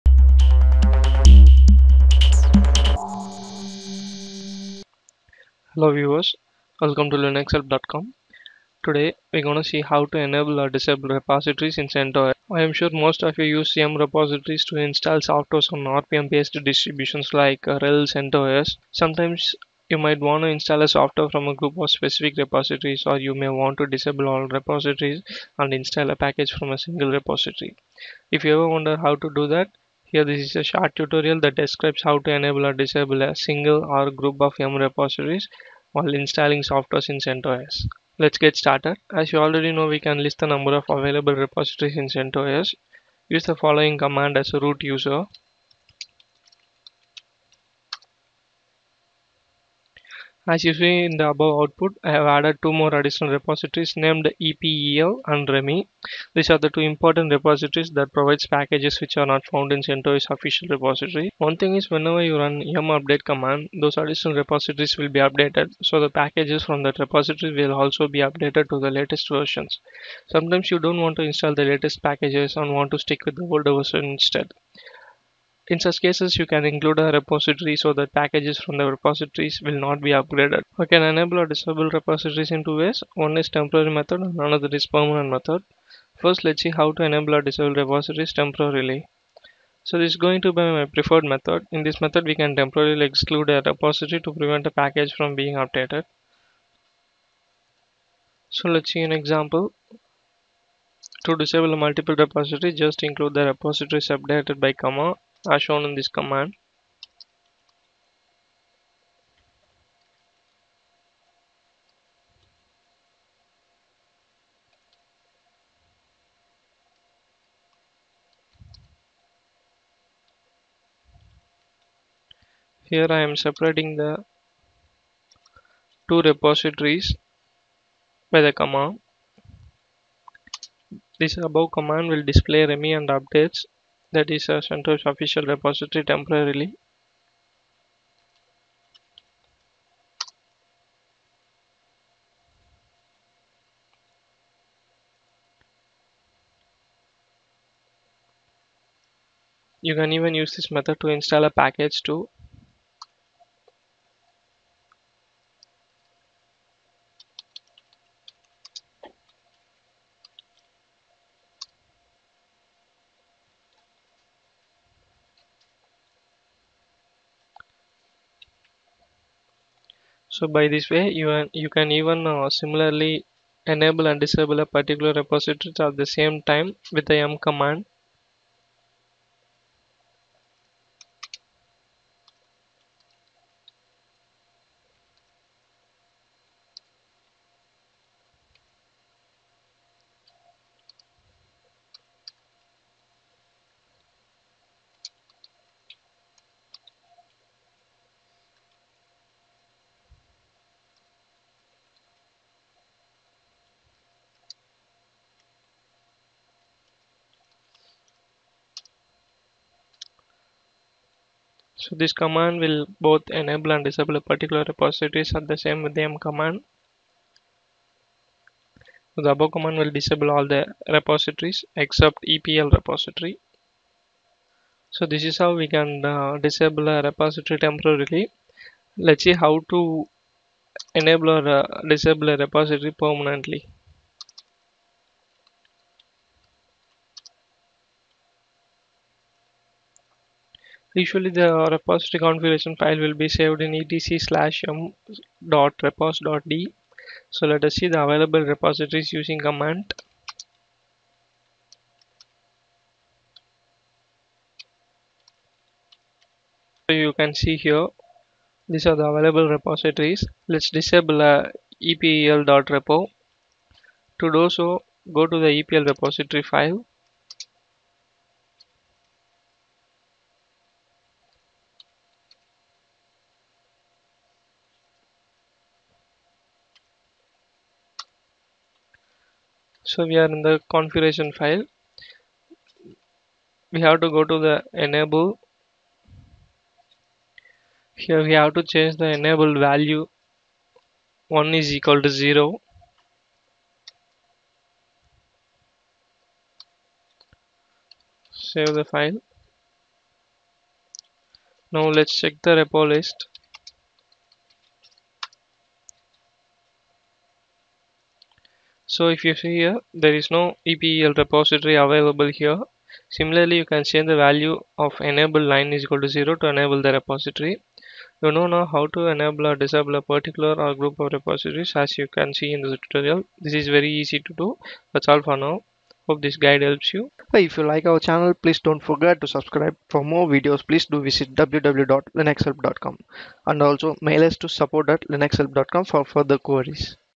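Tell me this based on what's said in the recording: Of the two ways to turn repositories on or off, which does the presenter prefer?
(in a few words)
temporary method.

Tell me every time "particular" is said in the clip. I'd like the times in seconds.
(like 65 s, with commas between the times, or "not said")
174 s, 214 s, 320 s.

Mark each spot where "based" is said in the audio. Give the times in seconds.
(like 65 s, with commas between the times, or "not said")
16 s.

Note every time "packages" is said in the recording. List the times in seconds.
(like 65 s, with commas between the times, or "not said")
26 s, 58 s, 66 s, 72 s, 78 s, 94 s, 151 s.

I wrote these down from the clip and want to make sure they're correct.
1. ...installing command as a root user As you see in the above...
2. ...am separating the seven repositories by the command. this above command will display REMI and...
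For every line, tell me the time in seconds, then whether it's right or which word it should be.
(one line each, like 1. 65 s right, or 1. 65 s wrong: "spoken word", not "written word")
1. 43 s wrong: "following", not "installing"
2. 123 s wrong: "two", not "seven".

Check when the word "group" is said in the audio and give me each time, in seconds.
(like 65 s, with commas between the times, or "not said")
21 s, 34 s, 320 s.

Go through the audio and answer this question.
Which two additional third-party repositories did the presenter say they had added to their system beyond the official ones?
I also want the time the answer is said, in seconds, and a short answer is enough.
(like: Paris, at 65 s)
EPEL and REMI, at 54 s.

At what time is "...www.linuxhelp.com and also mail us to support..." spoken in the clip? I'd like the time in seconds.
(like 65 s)
331 s.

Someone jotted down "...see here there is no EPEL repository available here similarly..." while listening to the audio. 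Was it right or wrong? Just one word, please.
right.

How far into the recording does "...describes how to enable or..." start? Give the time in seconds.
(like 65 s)
31 s.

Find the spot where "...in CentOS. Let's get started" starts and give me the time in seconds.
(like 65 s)
37 s.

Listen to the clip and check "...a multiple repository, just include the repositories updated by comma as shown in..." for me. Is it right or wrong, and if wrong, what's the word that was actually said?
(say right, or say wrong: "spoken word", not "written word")
right.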